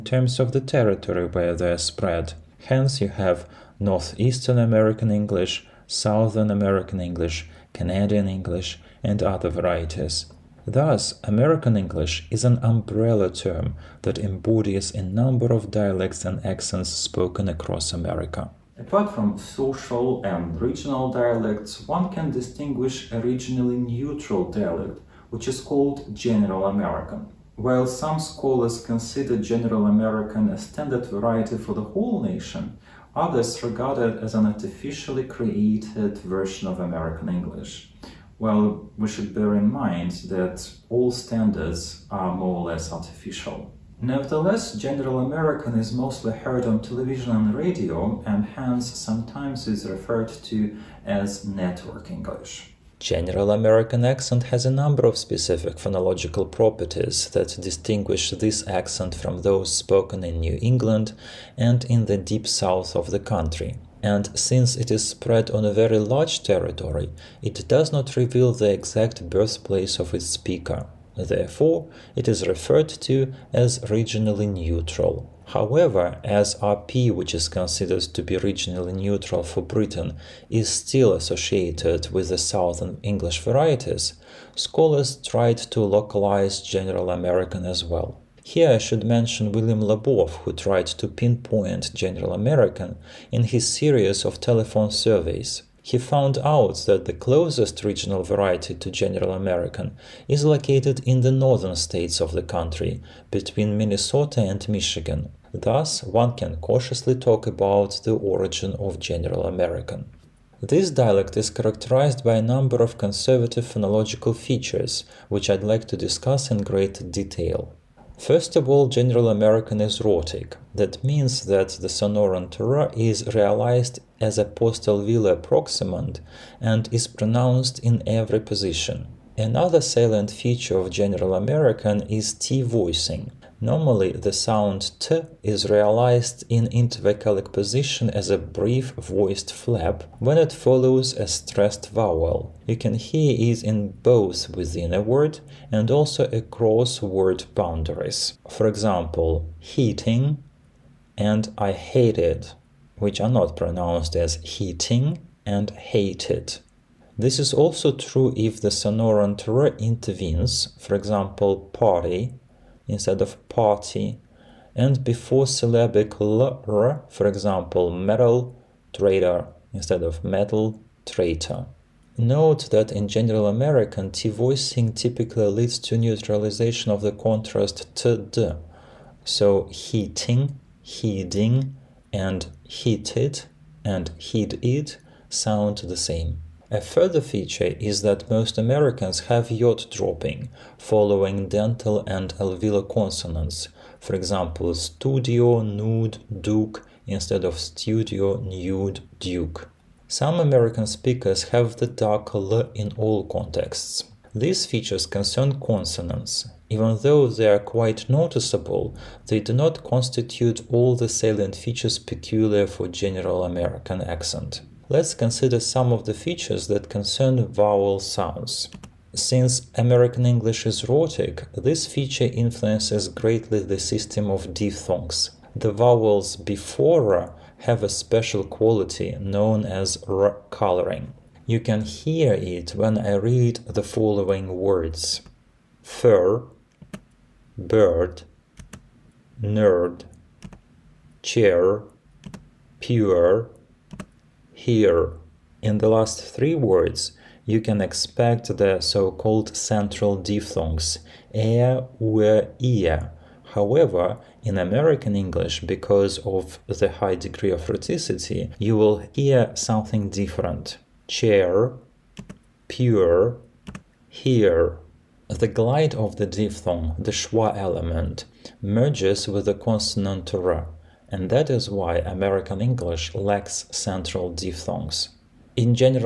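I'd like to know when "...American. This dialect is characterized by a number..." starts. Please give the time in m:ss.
1:49.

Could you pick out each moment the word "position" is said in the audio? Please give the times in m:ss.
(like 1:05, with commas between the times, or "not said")
2:08, 2:17.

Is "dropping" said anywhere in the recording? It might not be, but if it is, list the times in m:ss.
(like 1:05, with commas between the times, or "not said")
3:09.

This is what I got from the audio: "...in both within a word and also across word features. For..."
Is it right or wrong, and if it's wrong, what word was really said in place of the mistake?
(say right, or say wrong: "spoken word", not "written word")
wrong: "boundaries", not "features".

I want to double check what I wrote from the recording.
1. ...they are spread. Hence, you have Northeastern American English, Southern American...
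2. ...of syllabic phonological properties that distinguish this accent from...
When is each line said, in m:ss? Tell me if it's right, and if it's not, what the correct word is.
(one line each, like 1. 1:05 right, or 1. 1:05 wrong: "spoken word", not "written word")
1. 0:01 right
2. 0:55 wrong: "specific", not "syllabic".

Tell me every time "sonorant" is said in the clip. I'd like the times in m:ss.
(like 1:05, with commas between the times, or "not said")
2:01, 2:38.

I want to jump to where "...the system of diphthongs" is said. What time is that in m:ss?
3:43.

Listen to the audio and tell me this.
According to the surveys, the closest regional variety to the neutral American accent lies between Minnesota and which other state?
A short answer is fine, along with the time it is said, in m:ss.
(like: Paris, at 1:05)
Michigan, at 1:44.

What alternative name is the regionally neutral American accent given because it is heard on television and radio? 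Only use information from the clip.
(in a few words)
network English.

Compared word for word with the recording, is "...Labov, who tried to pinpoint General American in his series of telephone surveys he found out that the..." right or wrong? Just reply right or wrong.
right.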